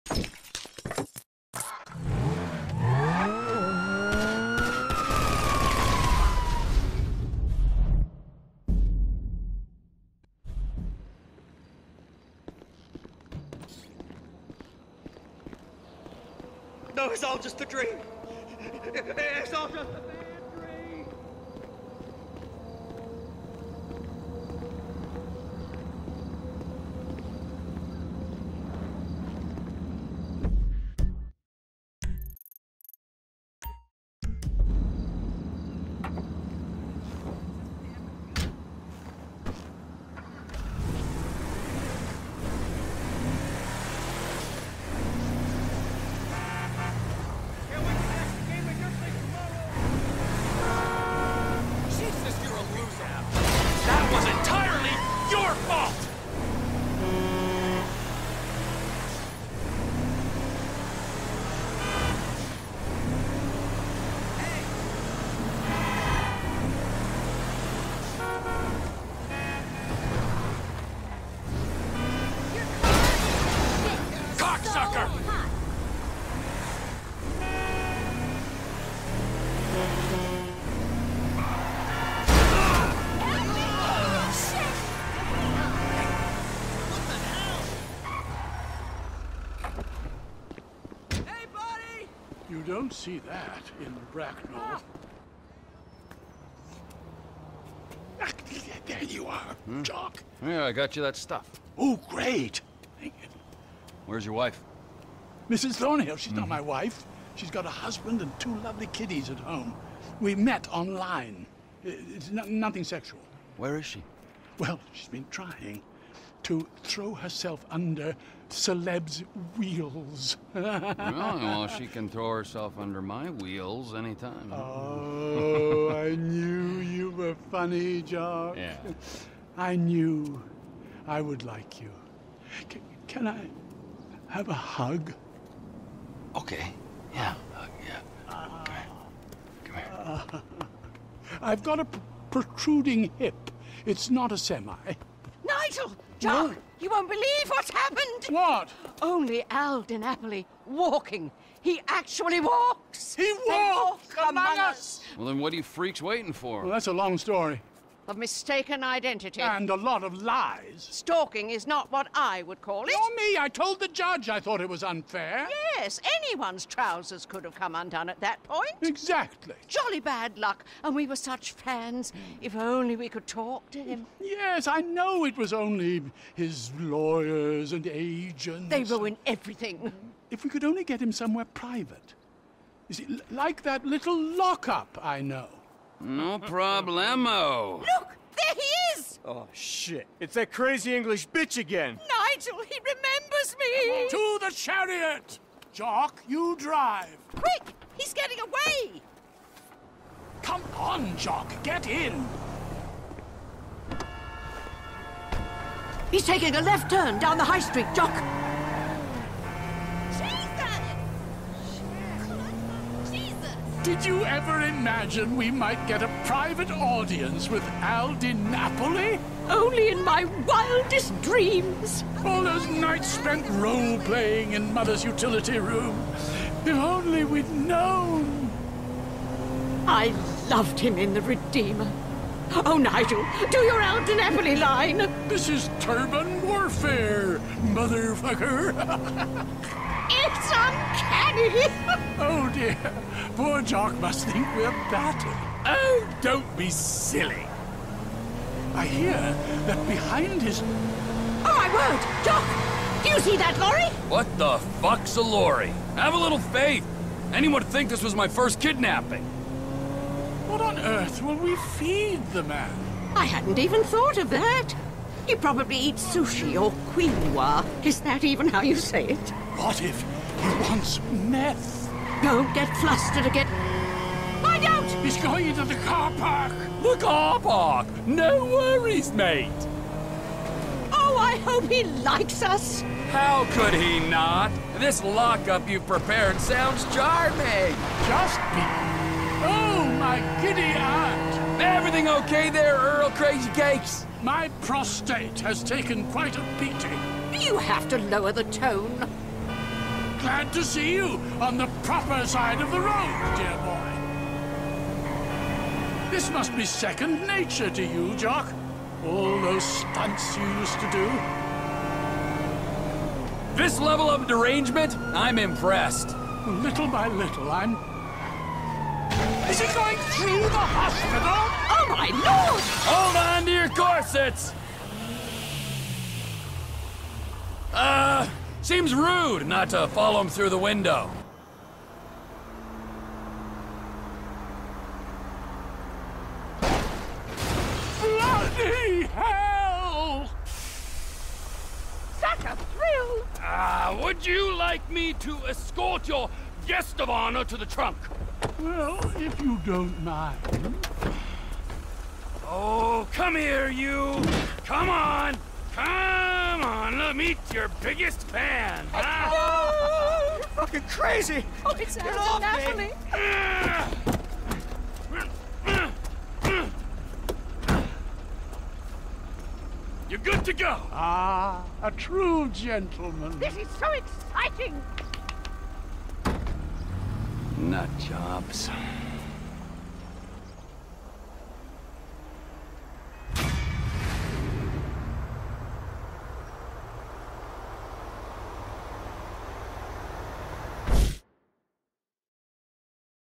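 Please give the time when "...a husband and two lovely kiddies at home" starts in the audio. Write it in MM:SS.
01:47.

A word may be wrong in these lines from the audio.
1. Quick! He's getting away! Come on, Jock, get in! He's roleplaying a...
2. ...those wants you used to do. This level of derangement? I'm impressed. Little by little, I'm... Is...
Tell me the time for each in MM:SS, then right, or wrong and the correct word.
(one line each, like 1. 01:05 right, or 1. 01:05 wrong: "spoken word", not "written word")
1. 03:17 wrong: "taking", not "roleplaying"
2. 05:09 wrong: "stunts", not "wants".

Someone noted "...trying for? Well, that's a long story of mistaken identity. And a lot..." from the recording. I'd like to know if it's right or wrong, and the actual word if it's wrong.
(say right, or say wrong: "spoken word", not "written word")
wrong: "waiting", not "trying".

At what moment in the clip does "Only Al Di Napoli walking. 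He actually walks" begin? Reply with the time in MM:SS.
02:29.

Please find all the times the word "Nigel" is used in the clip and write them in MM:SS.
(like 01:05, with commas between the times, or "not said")
03:12, 03:52.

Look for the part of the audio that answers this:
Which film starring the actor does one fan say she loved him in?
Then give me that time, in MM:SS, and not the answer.
03:51.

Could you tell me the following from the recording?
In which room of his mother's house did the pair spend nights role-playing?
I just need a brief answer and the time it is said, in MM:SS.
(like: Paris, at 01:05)
utility room, at 03:45.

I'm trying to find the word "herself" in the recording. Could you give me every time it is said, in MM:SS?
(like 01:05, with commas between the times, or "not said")
01:57, 02:02.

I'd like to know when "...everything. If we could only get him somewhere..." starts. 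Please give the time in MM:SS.
02:59.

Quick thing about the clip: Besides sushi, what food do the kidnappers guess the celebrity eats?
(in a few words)
quinoa.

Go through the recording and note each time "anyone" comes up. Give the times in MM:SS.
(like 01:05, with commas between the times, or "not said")
02:46, 04:17.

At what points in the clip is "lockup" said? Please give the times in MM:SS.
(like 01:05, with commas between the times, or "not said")
03:04, 04:45.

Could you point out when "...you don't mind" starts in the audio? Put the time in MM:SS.
05:49.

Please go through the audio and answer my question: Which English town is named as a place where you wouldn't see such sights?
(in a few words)
Bracknell.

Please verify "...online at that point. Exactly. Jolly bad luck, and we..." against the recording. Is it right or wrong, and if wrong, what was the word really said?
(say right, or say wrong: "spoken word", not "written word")
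wrong: "undone", not "online".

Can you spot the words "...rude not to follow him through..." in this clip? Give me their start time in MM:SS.
05:28.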